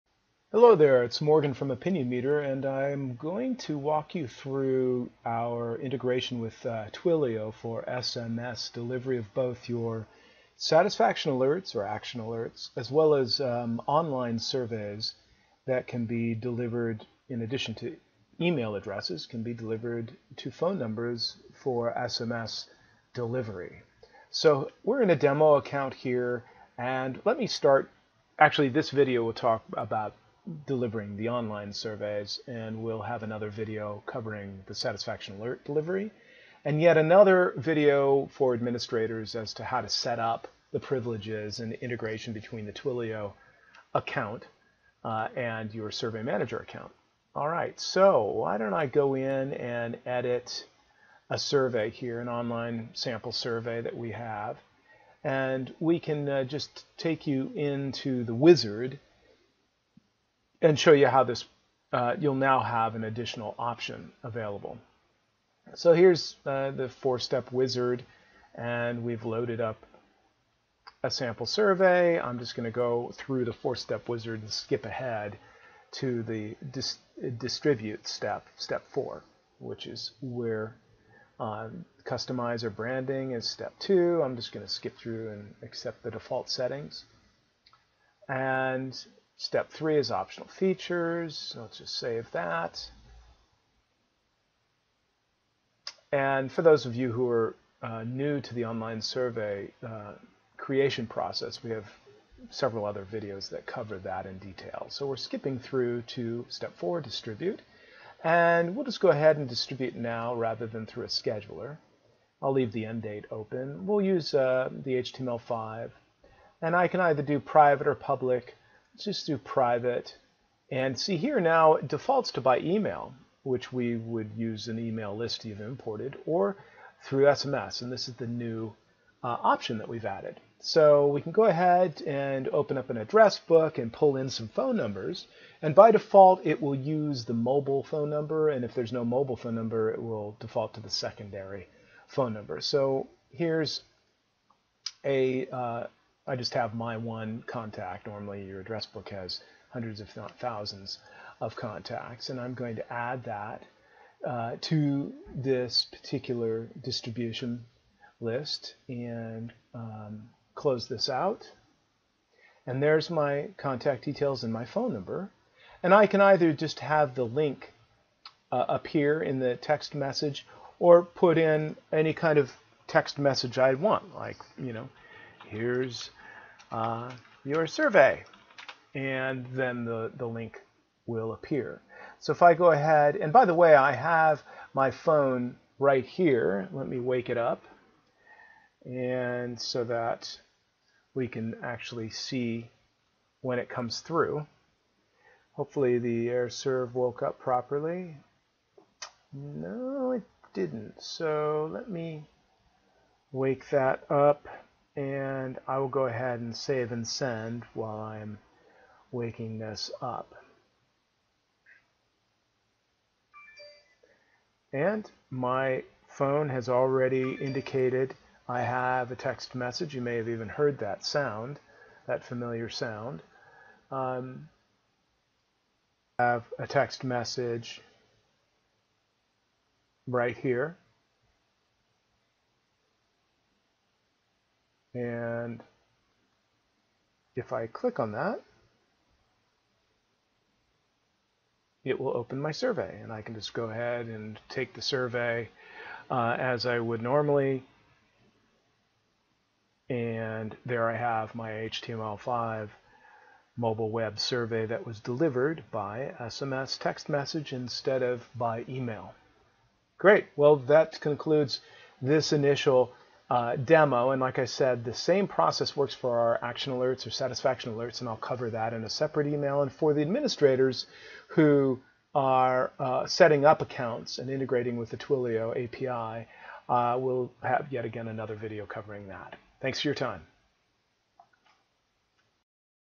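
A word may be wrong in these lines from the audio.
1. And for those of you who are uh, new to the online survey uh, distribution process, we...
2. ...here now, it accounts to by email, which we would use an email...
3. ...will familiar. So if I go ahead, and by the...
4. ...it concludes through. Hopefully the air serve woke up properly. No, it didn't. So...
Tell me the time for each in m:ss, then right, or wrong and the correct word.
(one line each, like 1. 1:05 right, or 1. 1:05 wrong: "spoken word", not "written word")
1. 1:36 wrong: "creation", not "distribution"
2. 2:01 wrong: "defaults", not "accounts"
3. 3:01 wrong: "appear", not "familiar"
4. 3:13 wrong: "comes", not "concludes".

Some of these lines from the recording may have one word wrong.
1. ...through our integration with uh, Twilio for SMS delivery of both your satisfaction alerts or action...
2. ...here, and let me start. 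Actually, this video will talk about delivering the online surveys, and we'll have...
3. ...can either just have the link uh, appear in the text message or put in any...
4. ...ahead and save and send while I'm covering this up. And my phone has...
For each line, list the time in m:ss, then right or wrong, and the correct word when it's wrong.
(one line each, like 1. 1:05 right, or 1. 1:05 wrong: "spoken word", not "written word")
1. 0:04 right
2. 0:25 right
3. 2:46 right
4. 3:26 wrong: "waking", not "covering".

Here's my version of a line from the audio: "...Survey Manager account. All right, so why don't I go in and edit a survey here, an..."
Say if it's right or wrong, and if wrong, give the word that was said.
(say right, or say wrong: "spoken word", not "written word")
right.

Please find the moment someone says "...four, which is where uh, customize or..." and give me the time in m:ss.
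1:18.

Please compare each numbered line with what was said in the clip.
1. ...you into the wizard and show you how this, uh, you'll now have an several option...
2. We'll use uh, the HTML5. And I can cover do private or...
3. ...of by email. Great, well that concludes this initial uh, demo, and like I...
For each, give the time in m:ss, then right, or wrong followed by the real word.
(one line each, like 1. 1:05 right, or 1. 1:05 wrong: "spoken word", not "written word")
1. 0:57 wrong: "additional", not "several"
2. 1:53 wrong: "either", not "cover"
3. 4:18 right.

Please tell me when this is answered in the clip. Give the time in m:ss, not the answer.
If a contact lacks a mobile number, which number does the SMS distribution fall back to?
2:20.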